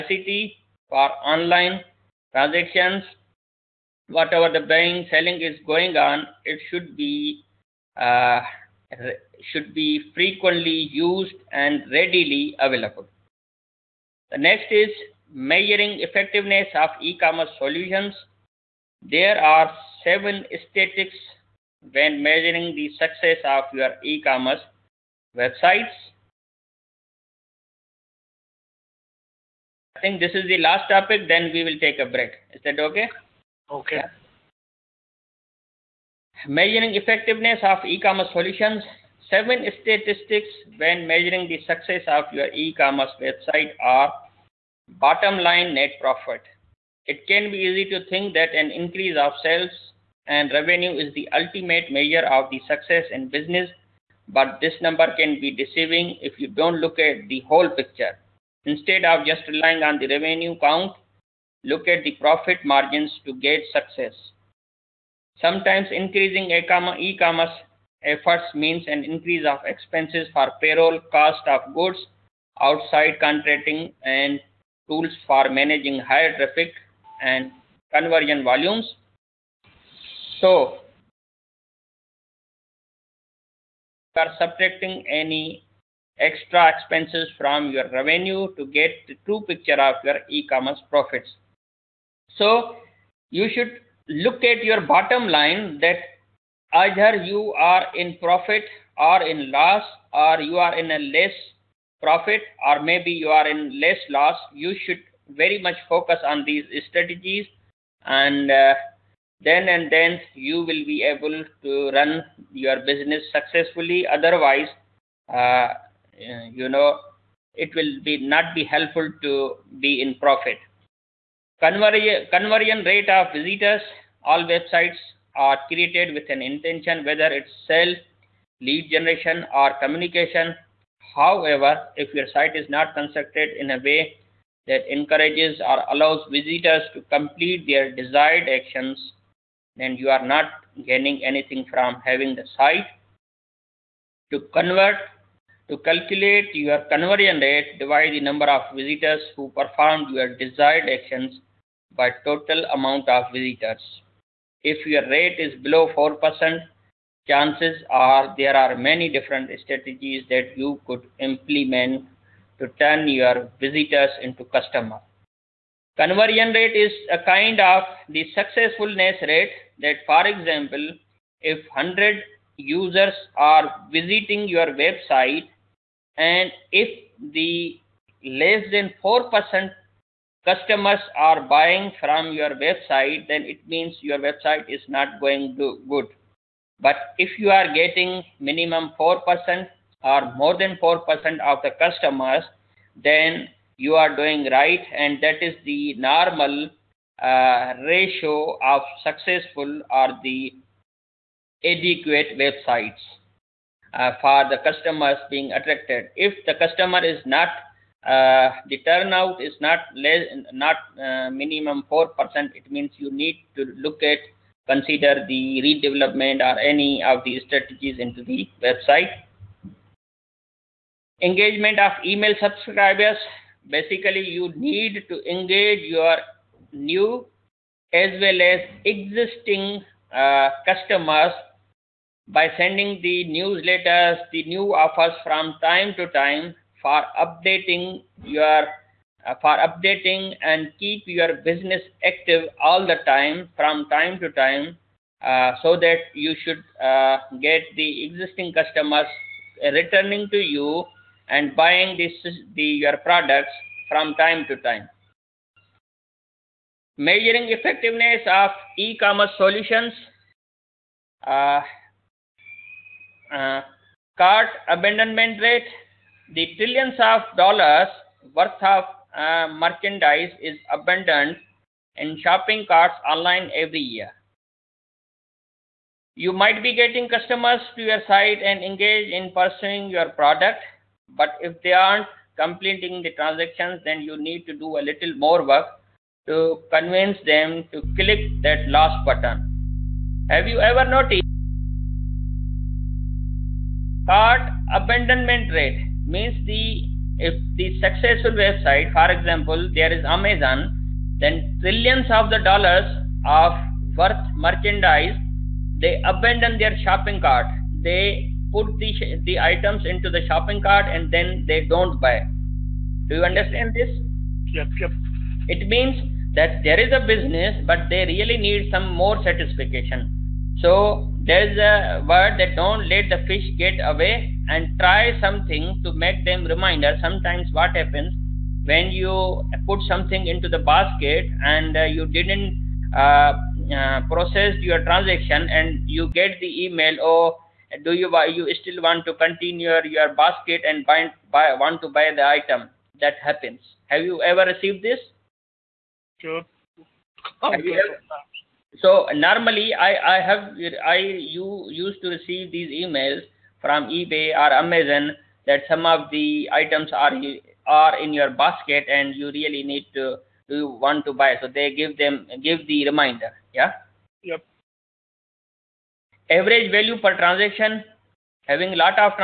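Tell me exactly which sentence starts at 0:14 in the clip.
The next is measuring effectiveness of e-commerce solutions.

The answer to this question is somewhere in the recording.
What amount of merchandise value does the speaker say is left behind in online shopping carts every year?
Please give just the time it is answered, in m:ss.
4:26.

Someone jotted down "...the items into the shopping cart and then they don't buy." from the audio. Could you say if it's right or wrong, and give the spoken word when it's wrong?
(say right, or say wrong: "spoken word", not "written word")
right.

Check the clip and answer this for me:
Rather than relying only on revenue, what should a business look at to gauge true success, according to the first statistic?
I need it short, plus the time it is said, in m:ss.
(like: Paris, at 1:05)
Profit margins, at 1:02.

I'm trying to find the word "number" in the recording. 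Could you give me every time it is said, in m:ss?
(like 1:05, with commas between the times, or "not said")
0:54, 2:28.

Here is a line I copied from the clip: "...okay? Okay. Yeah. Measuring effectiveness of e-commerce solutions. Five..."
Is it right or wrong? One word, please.
wrong.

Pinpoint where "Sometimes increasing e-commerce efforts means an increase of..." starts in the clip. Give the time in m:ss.
1:05.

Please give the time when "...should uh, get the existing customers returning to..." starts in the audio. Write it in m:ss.
4:06.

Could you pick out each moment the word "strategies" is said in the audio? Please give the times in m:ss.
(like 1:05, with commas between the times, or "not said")
1:46, 2:39, 3:37.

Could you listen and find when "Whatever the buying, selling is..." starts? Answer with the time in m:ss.
0:04.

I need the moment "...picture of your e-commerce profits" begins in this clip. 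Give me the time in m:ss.
1:29.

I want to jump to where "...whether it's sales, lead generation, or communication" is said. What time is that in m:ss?
2:07.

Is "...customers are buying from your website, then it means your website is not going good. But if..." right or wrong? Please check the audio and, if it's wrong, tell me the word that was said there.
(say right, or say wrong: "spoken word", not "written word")
right.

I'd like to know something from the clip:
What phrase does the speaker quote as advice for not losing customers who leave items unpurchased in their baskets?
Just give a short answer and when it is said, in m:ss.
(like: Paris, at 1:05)
Don't let the fish get away, at 5:22.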